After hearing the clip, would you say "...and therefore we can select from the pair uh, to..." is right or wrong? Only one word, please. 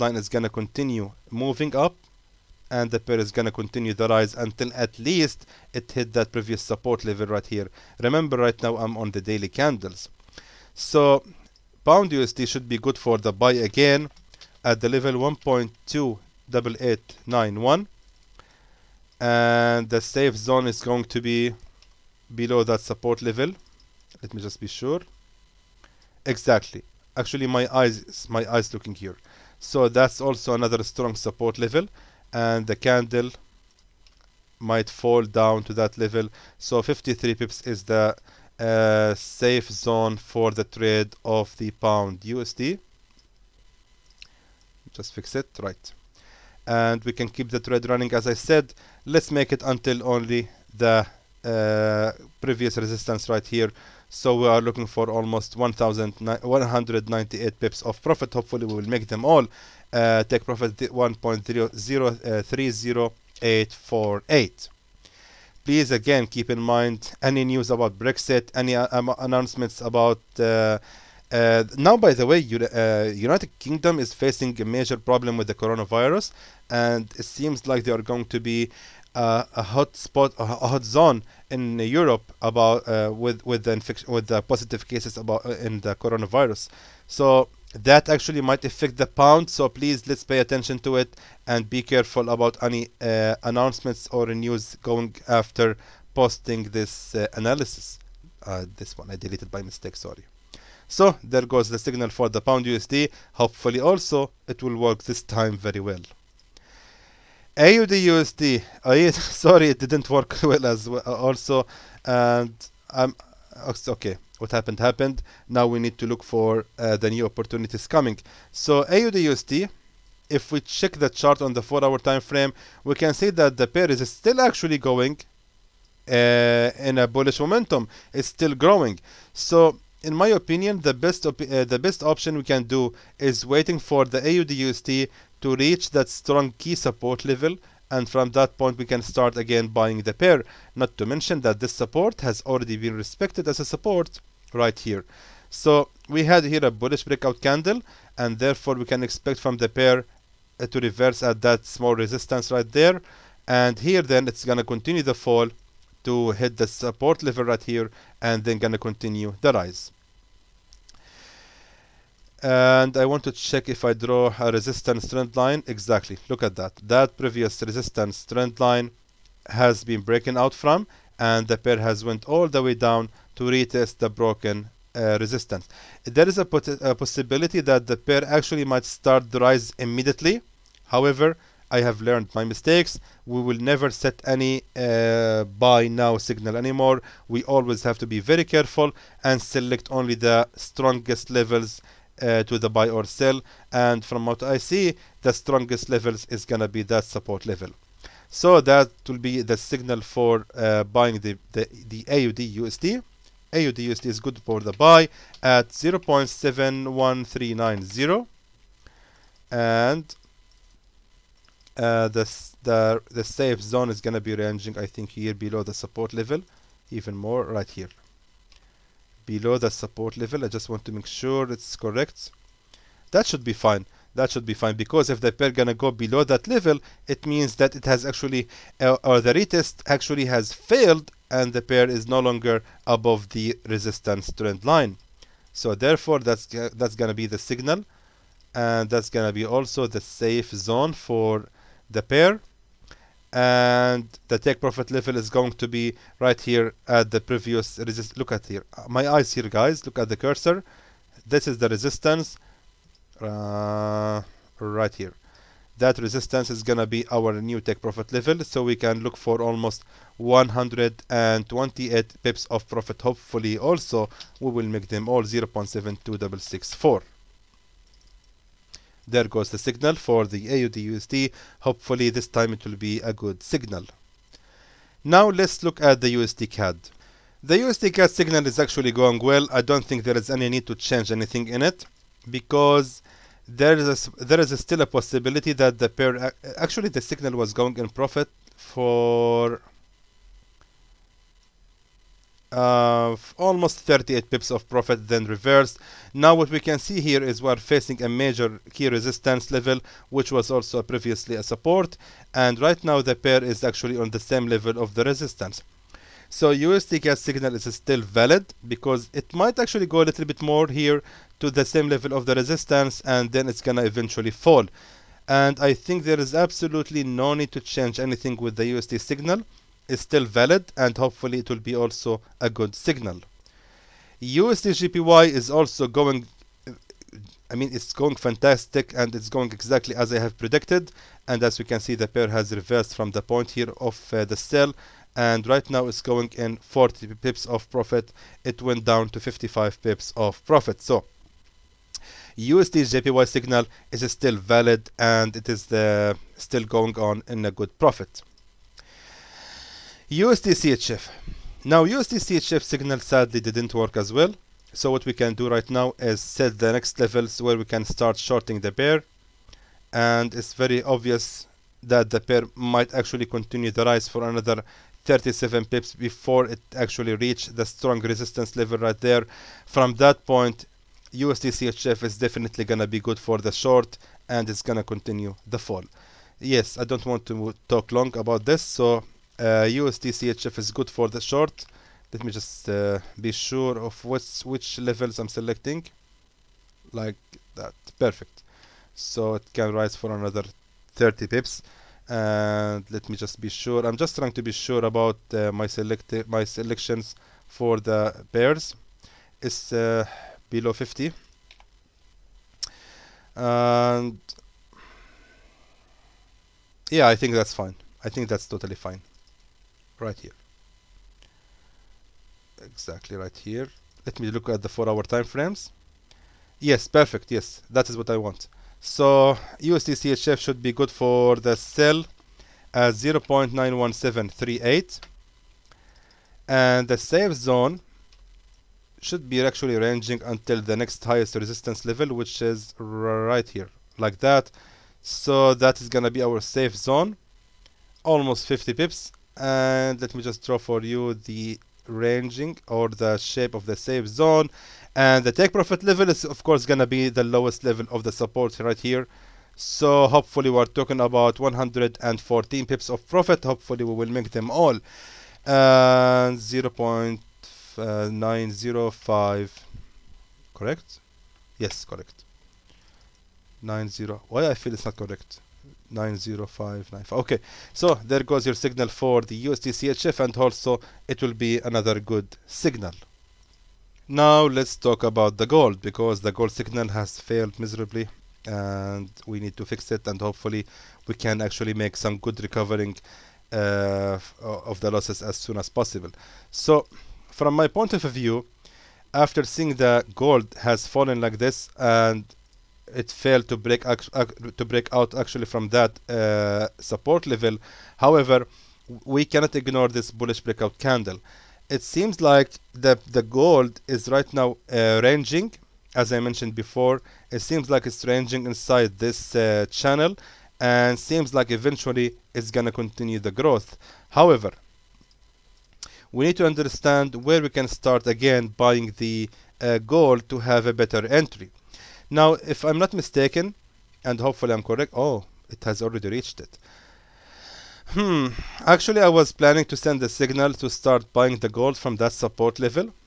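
wrong.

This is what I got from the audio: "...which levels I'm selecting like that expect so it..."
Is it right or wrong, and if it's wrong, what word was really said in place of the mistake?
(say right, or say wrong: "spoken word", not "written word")
wrong: "perfect", not "expect".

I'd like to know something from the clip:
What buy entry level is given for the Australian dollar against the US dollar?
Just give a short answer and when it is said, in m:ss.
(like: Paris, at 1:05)
0.71390, at 3:25.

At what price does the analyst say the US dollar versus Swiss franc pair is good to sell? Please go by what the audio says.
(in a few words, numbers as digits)
0.91738.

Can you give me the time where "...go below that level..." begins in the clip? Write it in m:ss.
3:45.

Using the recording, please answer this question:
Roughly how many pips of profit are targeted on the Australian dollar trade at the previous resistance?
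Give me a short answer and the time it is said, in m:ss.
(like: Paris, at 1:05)
128, at 4:20.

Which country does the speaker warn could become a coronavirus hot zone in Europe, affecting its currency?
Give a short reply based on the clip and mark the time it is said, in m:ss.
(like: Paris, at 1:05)
United Kingdom, at 1:13.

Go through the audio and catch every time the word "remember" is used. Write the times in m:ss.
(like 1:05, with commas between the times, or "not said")
0:08.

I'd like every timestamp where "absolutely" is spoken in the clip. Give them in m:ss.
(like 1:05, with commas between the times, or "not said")
5:16.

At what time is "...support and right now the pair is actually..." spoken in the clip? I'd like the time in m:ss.
5:01.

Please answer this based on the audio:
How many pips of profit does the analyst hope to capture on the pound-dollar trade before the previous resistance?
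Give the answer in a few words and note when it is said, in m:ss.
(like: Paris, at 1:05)
1198, at 0:55.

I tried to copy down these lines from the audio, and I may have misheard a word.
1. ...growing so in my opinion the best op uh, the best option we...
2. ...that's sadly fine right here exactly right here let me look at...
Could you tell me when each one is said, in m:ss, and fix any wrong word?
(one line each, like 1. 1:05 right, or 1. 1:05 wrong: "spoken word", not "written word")
1. 2:08 right
2. 6:48 wrong: "totally", not "sadly".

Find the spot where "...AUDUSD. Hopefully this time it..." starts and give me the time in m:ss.
4:30.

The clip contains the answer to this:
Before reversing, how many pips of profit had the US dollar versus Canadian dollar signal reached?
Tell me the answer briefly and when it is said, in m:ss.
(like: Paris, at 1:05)
38, at 4:53.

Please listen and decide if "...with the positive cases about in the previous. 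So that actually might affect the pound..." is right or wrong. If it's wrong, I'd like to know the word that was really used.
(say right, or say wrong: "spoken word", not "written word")
wrong: "coronavirus", not "previous".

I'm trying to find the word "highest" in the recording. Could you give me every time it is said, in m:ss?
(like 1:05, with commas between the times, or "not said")
7:11.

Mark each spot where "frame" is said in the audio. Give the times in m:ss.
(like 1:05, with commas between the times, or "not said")
2:02, 6:55.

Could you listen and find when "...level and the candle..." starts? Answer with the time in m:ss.
0:31.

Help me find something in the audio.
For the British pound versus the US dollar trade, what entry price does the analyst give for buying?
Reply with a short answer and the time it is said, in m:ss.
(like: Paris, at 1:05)
1.28891, at 0:15.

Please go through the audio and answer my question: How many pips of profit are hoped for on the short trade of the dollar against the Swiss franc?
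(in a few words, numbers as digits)
114.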